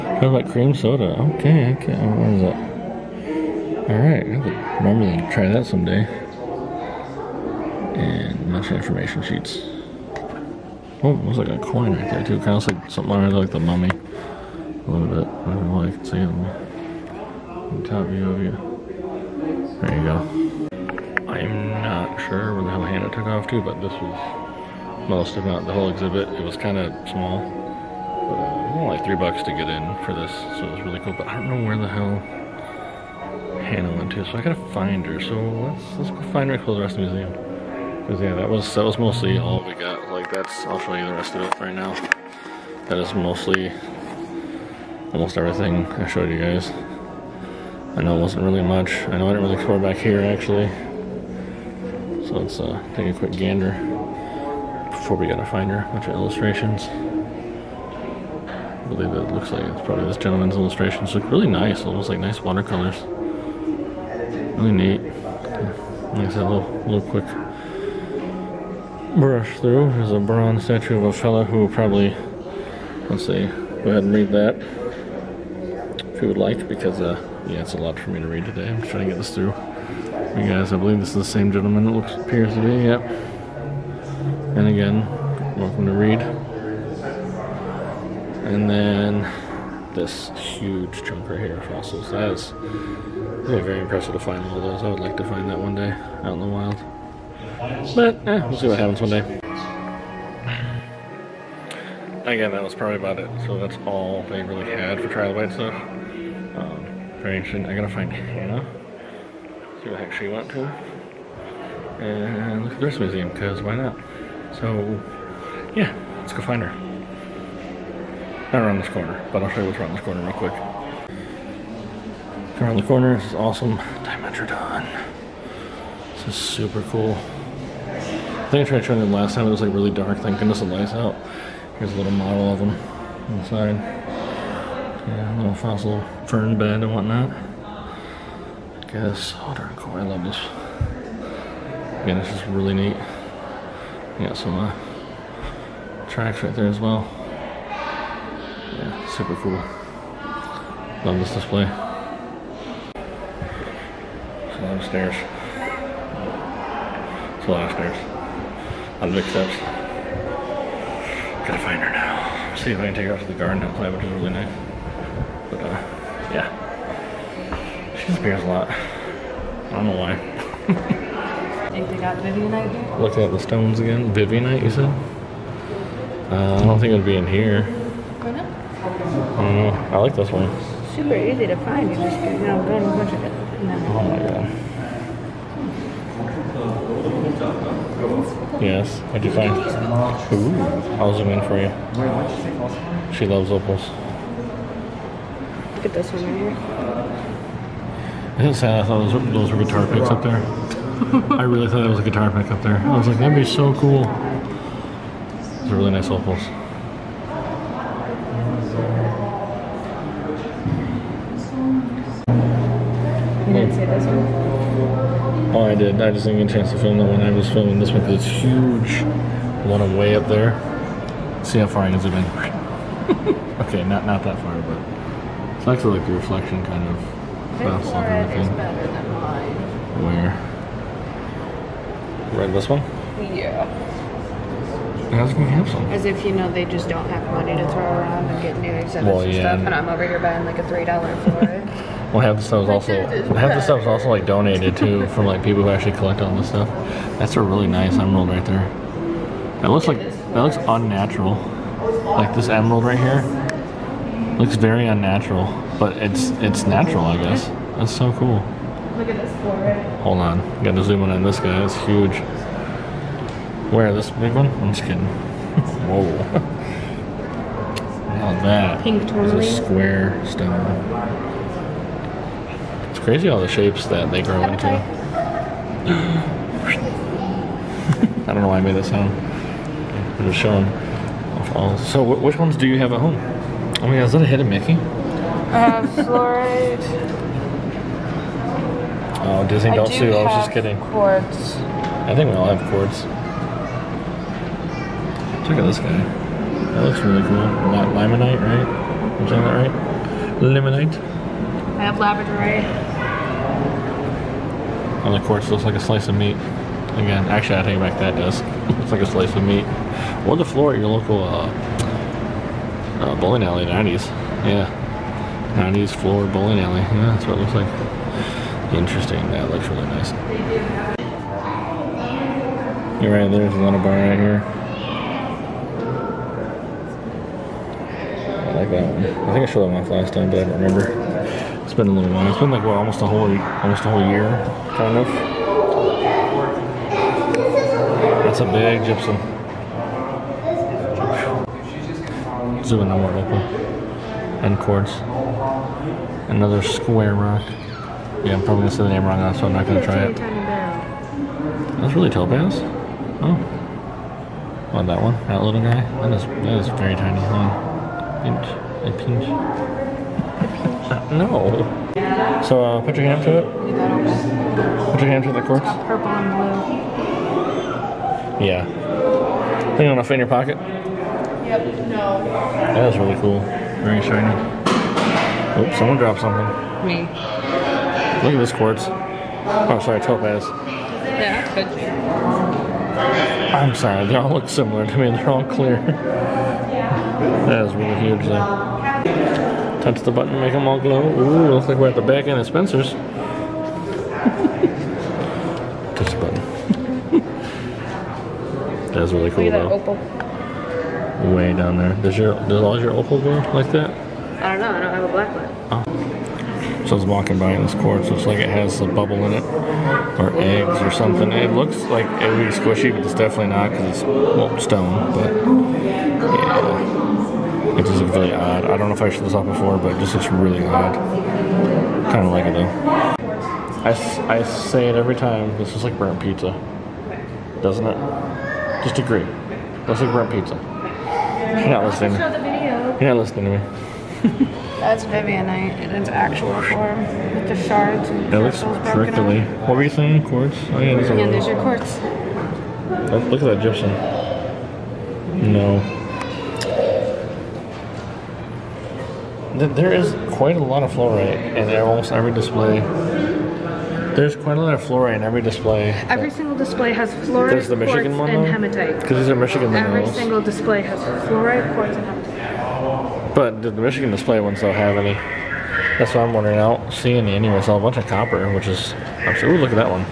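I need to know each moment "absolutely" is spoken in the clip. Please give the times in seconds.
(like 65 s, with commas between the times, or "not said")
469 s.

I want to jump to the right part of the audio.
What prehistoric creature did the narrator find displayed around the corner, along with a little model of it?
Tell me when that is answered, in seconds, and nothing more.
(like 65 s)
124 s.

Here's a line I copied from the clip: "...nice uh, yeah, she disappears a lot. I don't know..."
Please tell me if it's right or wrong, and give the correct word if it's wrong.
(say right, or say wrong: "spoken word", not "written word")
right.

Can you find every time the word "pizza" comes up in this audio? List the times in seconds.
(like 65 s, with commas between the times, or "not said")
426 s, 430 s.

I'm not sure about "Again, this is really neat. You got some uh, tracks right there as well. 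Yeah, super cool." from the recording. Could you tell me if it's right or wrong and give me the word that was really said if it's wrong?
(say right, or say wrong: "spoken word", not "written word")
right.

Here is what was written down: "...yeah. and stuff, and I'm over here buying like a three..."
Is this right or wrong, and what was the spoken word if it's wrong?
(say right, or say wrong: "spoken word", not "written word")
right.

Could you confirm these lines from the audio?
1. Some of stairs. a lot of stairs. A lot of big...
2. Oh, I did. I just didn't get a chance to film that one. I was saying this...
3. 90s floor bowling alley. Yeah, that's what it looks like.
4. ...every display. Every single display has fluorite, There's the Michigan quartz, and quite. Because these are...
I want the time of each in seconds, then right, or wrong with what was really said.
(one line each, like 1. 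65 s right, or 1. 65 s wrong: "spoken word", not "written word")
1. 154 s right
2. 215 s wrong: "filming", not "saying"
3. 315 s right
4. 455 s wrong: "hematite", not "quite".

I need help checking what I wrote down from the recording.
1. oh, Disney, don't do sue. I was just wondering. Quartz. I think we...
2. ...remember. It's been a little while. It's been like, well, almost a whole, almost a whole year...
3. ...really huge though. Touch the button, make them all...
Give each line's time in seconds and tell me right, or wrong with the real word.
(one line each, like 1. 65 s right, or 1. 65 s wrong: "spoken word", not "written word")
1. 289 s wrong: "kidding", not "wondering"
2. 330 s right
3. 387 s right.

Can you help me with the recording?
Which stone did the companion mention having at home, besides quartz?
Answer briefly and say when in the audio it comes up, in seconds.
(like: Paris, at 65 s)
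Labradorite, at 301 s.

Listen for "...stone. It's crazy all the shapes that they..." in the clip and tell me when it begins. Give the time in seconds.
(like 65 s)
270 s.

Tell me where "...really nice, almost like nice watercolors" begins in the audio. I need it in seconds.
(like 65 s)
61 s.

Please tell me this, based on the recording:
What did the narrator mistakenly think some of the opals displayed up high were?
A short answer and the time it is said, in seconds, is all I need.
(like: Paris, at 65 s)
Guitar picks, at 199 s.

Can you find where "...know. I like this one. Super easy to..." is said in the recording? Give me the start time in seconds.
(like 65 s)
179 s.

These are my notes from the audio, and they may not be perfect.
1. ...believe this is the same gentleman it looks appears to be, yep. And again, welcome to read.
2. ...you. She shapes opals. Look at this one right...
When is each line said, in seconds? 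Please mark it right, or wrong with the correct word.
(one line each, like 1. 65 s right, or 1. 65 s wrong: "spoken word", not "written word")
1. 80 s right
2. 191 s wrong: "loves", not "shapes".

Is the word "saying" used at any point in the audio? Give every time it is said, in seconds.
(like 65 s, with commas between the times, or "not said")
299 s, 439 s.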